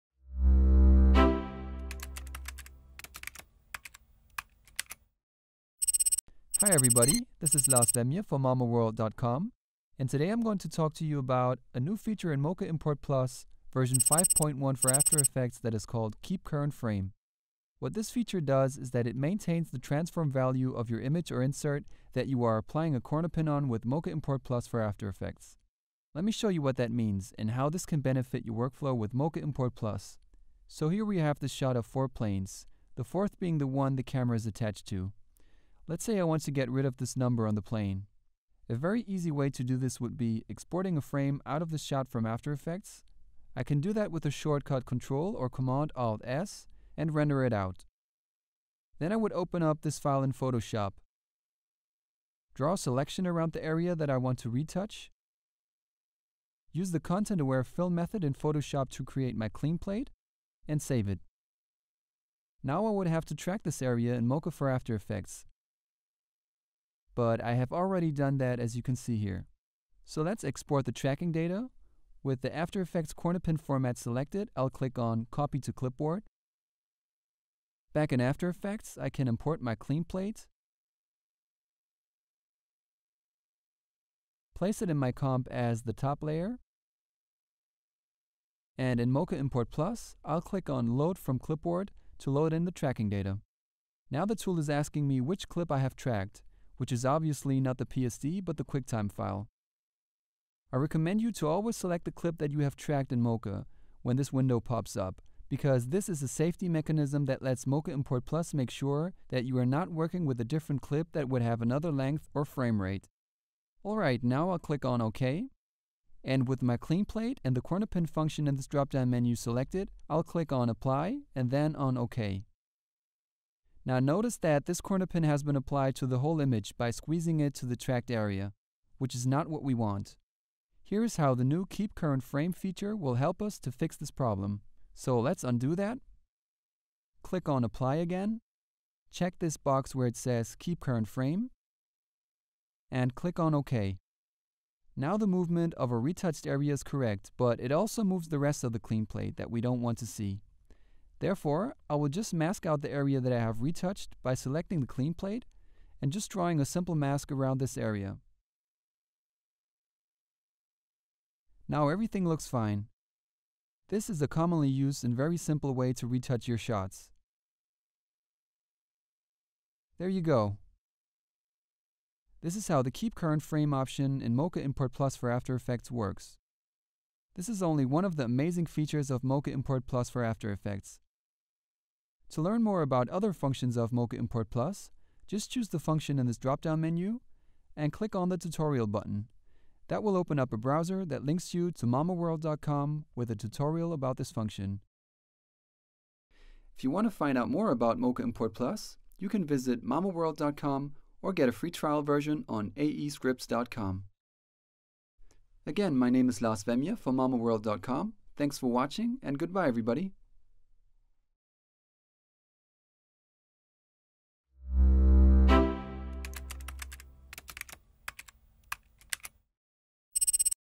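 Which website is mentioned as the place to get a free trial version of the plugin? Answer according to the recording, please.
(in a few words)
aescripts.com.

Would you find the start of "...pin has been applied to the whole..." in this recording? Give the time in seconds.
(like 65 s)
125 s.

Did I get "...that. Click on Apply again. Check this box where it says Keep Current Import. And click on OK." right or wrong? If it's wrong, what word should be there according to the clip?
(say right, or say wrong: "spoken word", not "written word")
wrong: "Frame", not "Import".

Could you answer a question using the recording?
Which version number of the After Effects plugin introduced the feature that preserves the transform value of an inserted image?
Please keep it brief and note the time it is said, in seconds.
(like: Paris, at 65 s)
5.1, at 13 s.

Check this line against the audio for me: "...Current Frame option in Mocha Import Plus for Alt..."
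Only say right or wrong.
wrong.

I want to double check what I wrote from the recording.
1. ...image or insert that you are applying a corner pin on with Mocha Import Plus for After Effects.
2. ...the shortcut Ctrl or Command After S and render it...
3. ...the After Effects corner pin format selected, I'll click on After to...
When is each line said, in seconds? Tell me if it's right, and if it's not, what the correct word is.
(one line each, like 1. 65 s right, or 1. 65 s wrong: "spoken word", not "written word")
1. 20 s right
2. 44 s wrong: "Alt", not "After"
3. 72 s wrong: "Copy", not "After".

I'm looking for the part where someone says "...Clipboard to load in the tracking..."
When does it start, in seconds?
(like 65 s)
91 s.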